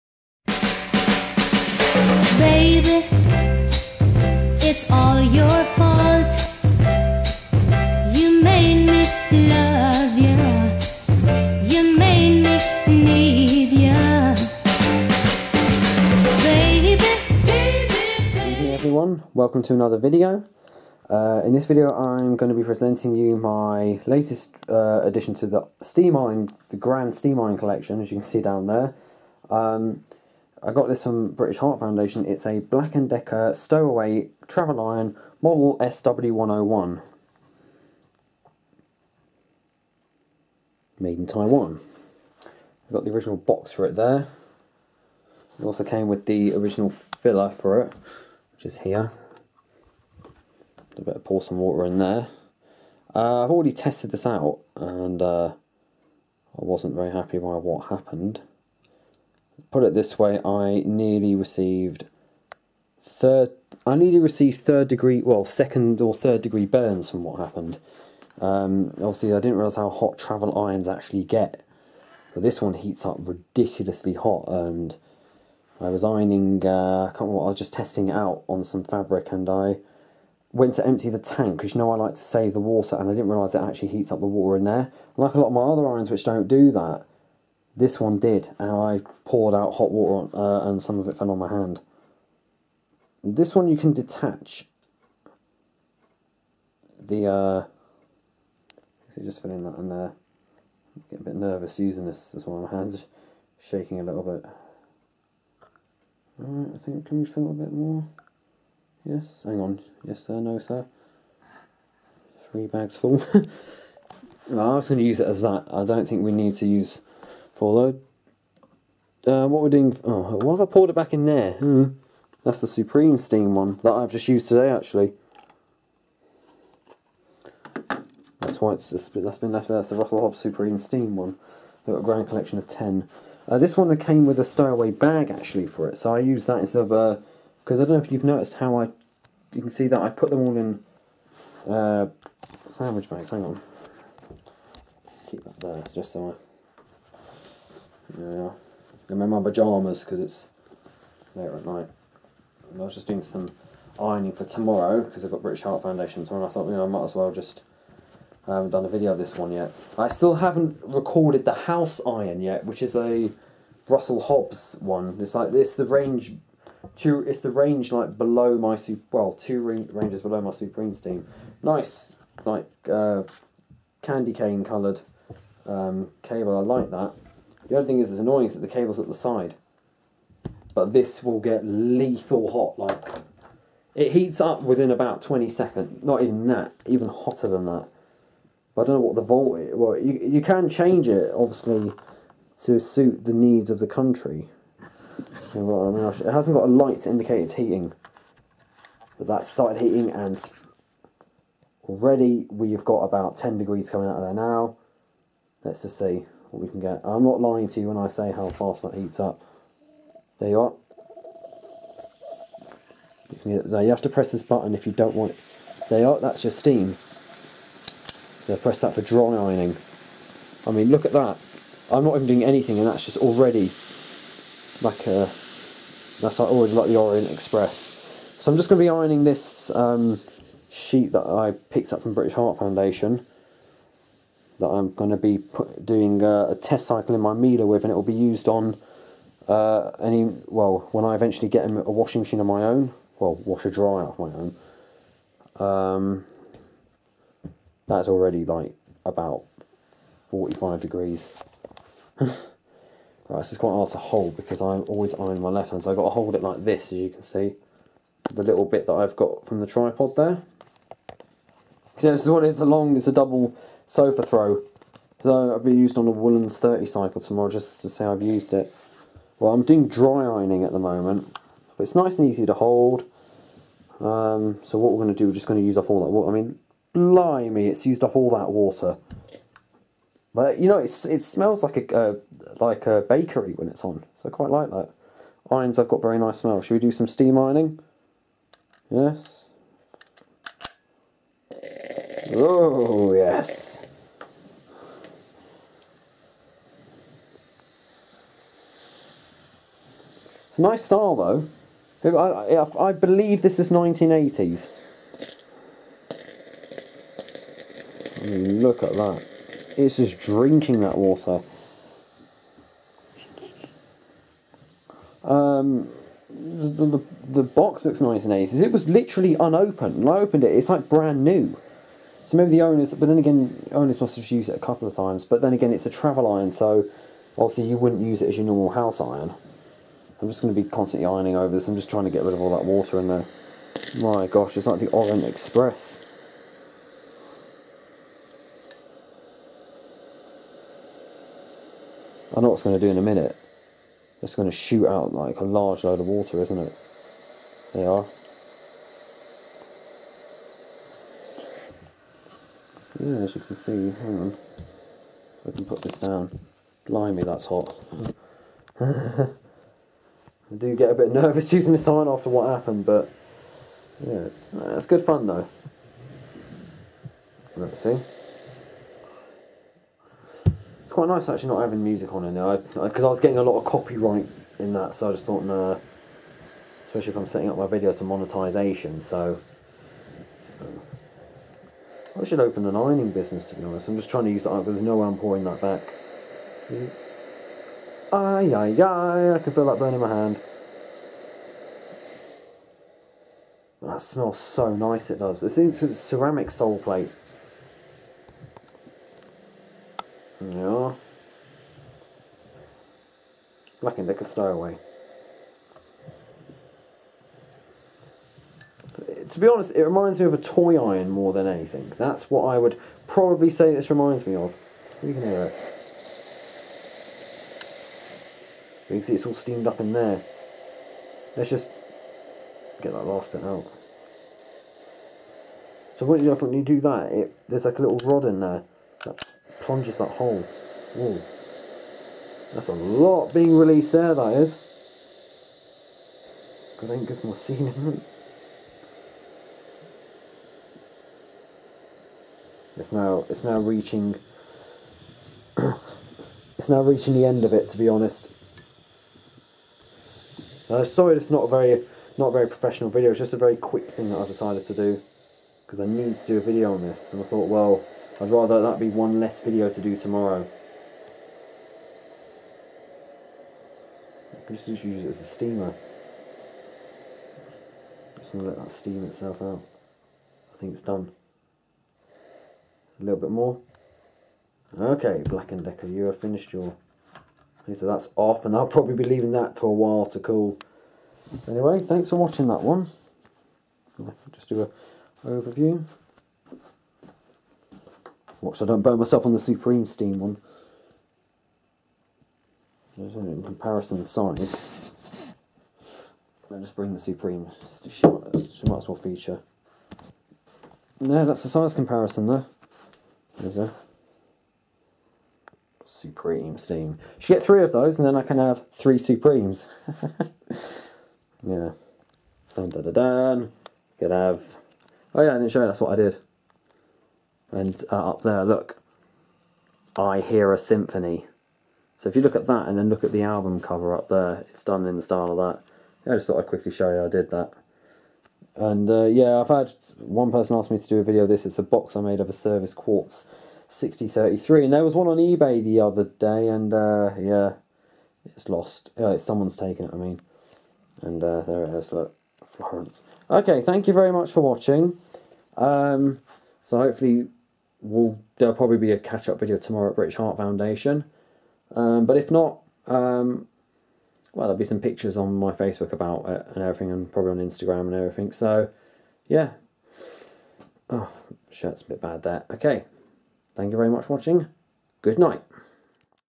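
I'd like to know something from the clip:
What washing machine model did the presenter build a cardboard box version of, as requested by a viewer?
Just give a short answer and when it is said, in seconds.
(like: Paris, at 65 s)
Servis Quartz 6033, at 532 s.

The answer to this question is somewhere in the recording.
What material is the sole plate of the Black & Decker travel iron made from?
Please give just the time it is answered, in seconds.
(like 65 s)
395 s.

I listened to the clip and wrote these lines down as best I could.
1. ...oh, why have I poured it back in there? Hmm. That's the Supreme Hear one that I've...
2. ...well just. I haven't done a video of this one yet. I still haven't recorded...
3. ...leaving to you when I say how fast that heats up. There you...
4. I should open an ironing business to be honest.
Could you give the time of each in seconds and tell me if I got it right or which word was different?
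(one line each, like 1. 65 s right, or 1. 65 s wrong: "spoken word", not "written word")
1. 120 s wrong: "Steam", not "Hear"
2. 157 s right
3. 207 s wrong: "lying", not "leaving"
4. 382 s right.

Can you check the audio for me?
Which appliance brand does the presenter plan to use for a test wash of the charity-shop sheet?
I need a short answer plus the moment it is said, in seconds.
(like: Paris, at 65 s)
Miele, at 237 s.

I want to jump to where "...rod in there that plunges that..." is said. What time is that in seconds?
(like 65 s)
428 s.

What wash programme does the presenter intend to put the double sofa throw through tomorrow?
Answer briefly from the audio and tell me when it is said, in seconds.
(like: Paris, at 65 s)
woolen 30, at 266 s.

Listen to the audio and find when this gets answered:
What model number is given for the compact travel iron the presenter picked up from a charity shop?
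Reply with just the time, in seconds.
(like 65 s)
35 s.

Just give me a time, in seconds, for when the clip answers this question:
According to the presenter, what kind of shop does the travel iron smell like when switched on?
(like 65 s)
283 s.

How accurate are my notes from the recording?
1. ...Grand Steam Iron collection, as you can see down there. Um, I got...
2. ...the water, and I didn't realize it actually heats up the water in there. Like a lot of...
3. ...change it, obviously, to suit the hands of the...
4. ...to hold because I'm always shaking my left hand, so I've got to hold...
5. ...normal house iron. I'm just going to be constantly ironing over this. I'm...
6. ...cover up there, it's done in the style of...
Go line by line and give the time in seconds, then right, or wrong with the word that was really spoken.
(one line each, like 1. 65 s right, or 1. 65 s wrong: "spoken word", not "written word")
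1. 26 s right
2. 82 s right
3. 190 s wrong: "needs", not "hands"
4. 253 s wrong: "ironing", not "shaking"
5. 328 s right
6. 523 s right.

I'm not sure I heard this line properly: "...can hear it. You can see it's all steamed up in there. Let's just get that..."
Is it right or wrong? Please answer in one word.
right.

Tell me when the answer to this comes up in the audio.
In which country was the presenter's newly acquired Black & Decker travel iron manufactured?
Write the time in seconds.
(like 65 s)
41 s.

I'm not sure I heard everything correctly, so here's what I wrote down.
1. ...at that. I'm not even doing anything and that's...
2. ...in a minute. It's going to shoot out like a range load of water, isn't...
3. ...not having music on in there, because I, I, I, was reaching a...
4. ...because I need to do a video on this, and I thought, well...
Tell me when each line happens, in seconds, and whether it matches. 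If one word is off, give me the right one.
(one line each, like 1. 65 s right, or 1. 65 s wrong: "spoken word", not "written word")
1. 221 s right
2. 342 s wrong: "large", not "range"
3. 371 s wrong: "getting", not "reaching"
4. 455 s right.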